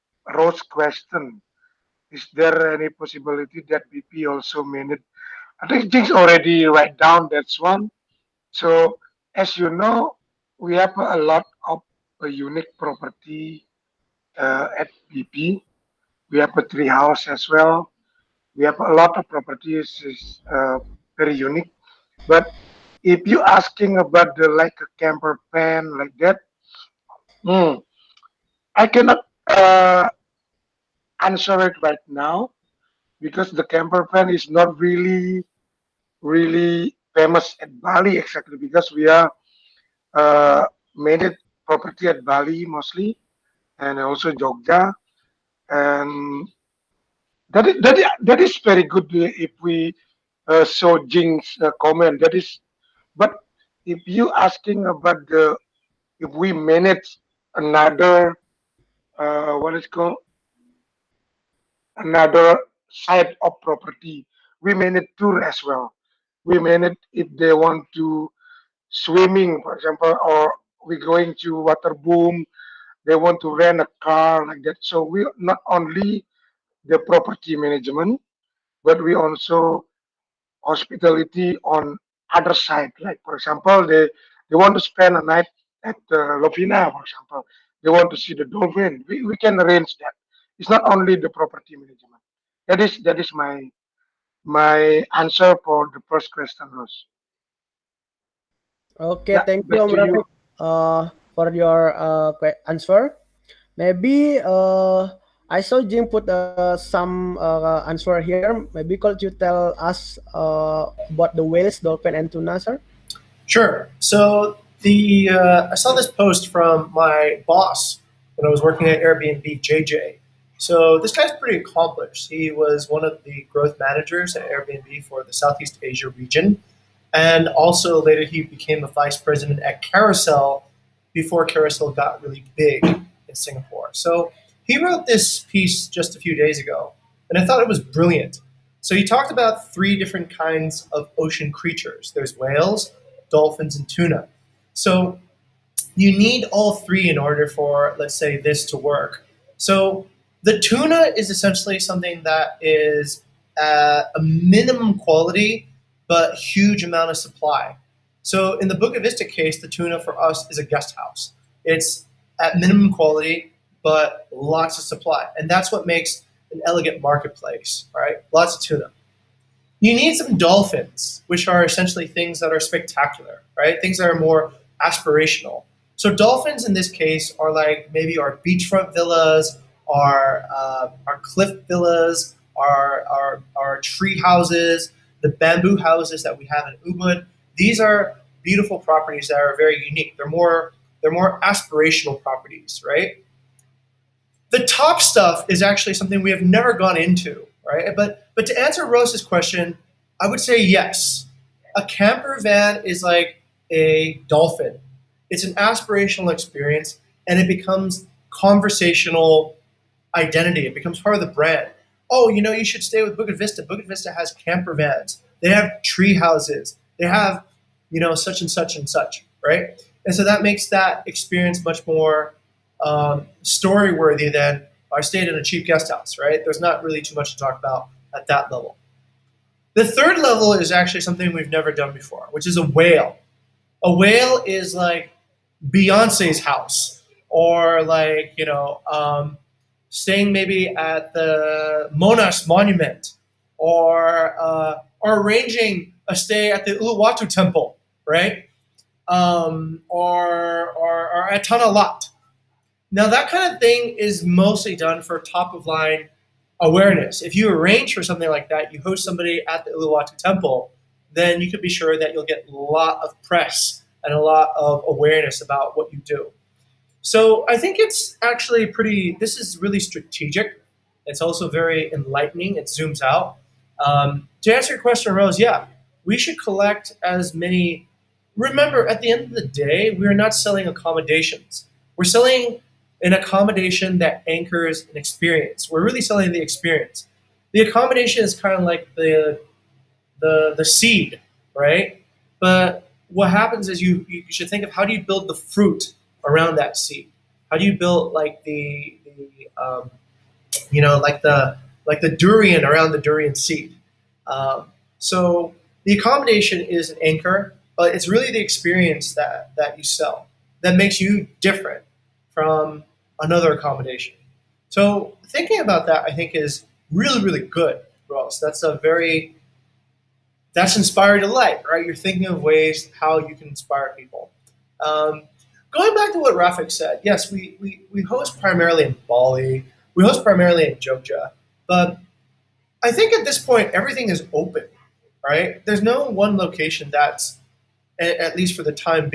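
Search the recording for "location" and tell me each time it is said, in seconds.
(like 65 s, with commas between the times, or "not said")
336 s.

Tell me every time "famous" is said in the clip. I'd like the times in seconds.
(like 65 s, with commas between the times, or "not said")
37 s.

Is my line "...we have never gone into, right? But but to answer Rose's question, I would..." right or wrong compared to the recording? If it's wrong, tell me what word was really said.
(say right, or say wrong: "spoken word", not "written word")
right.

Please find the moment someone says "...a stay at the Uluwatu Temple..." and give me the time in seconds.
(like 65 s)
246 s.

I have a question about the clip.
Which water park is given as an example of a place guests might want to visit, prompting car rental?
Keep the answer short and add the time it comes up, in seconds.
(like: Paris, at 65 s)
Waterbom, at 71 s.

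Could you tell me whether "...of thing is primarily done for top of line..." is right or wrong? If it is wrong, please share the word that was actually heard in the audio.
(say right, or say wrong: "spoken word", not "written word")
wrong: "mostly", not "primarily".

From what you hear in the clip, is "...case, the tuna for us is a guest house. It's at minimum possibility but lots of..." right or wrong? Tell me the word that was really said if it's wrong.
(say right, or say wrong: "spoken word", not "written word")
wrong: "quality", not "possibility".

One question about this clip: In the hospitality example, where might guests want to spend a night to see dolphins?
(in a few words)
Lovina.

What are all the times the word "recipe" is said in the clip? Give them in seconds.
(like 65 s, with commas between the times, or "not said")
not said.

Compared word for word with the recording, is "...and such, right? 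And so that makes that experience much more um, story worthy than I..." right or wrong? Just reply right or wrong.
right.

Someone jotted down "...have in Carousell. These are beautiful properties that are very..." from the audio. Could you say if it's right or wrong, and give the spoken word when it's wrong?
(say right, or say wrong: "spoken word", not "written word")
wrong: "Ubud", not "Carousell".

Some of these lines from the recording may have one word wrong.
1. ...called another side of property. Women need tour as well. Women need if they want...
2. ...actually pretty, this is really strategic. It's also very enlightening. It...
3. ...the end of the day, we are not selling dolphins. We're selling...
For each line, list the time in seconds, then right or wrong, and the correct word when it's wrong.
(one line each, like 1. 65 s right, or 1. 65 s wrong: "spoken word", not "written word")
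1. 59 s right
2. 268 s right
3. 279 s wrong: "accommodations", not "dolphins".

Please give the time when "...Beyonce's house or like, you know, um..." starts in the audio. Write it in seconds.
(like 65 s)
235 s.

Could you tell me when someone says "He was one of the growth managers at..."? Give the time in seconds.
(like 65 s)
122 s.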